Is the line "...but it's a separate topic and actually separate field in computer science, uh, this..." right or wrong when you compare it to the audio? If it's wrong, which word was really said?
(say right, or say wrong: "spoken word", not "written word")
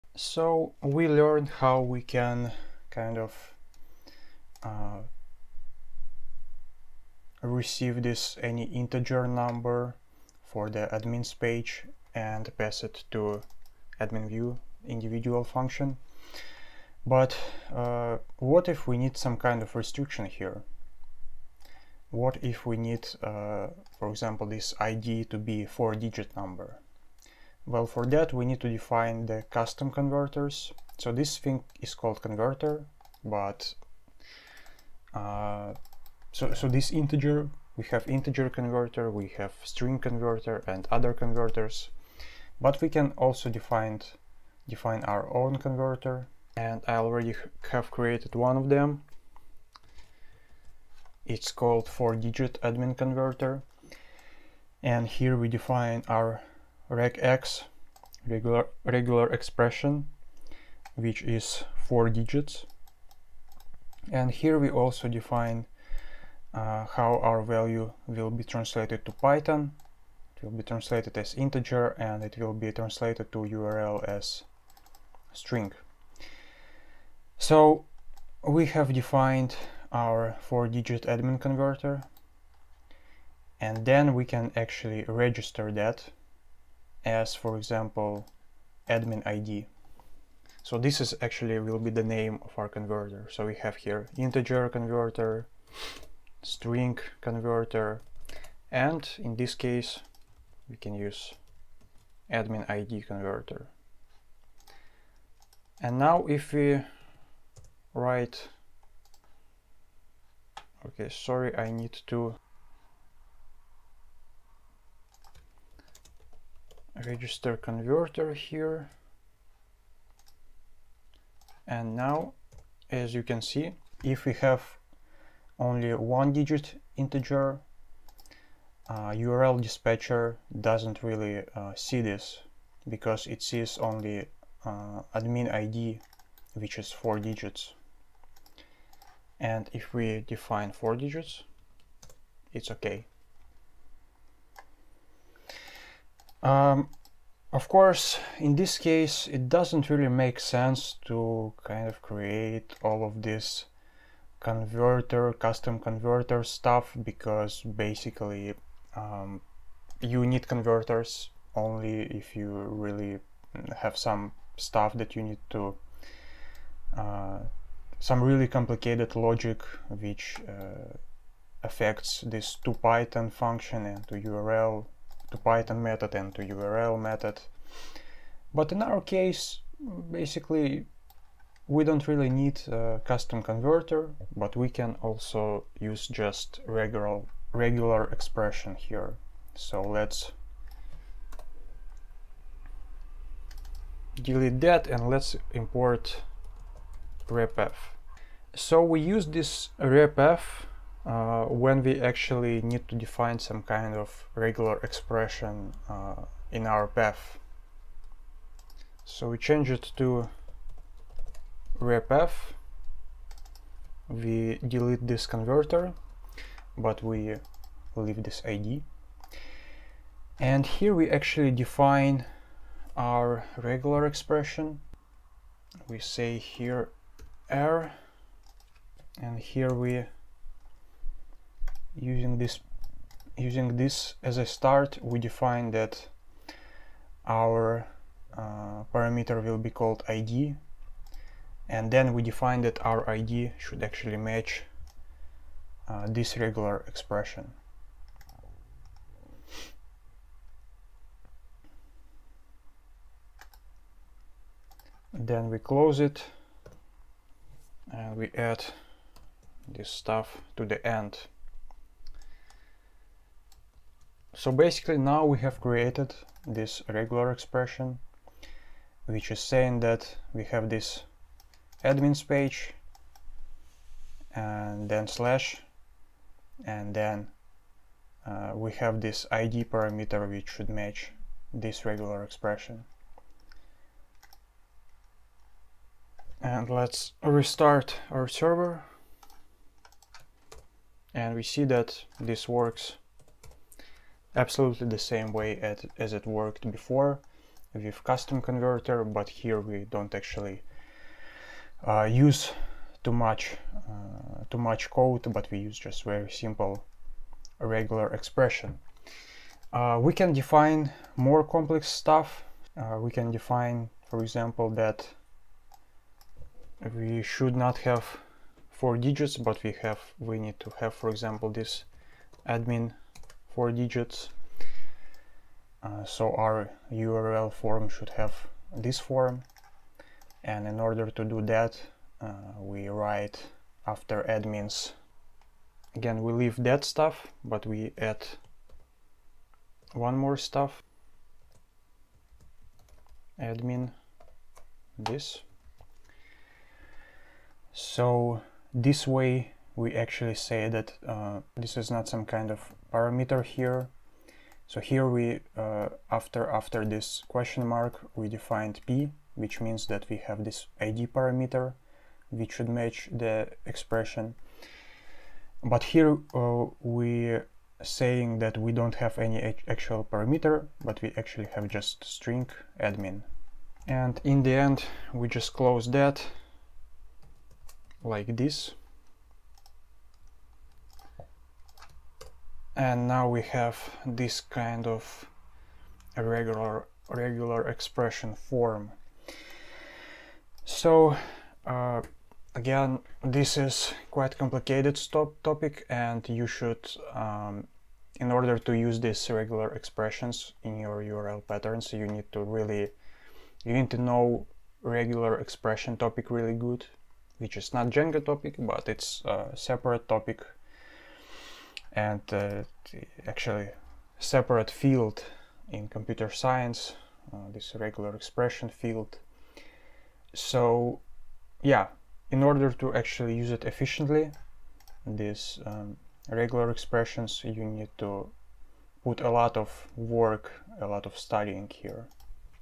right.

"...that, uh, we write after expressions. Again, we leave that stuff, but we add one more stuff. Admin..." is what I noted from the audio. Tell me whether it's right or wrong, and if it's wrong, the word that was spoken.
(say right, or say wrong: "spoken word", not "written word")
wrong: "admins", not "expressions".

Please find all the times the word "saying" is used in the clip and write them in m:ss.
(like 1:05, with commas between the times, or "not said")
4:29, 6:07.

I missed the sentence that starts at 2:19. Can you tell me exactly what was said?
And if we define four digits, it's okay.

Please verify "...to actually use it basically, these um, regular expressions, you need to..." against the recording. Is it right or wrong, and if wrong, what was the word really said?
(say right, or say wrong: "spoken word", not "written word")
wrong: "efficiently", not "basically".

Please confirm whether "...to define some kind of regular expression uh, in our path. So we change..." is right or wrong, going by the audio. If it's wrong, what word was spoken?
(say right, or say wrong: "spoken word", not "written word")
right.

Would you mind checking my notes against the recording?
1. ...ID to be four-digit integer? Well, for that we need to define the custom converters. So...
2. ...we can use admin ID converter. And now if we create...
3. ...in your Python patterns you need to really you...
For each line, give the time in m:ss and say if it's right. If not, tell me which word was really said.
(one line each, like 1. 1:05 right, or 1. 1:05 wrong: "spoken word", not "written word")
1. 0:24 wrong: "number", not "integer"
2. 1:40 wrong: "write", not "create"
3. 6:40 wrong: "URL", not "Python".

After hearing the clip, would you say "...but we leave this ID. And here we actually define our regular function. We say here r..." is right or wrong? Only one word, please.
wrong.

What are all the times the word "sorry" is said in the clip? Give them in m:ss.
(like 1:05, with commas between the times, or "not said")
1:51.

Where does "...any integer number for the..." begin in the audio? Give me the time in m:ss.
0:08.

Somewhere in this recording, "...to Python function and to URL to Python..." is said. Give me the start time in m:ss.
2:52.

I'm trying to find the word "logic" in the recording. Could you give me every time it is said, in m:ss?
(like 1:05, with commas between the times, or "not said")
2:49.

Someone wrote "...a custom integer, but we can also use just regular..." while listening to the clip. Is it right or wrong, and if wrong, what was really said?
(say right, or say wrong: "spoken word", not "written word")
wrong: "converter", not "integer".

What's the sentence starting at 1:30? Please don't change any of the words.
So this is actually will be the name of our converter.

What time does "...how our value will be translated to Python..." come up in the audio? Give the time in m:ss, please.
1:06.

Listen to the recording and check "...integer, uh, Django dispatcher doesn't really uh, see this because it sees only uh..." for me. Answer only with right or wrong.
wrong.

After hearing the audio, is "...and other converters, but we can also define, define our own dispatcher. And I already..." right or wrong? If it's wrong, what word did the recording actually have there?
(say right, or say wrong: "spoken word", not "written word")
wrong: "converter", not "dispatcher".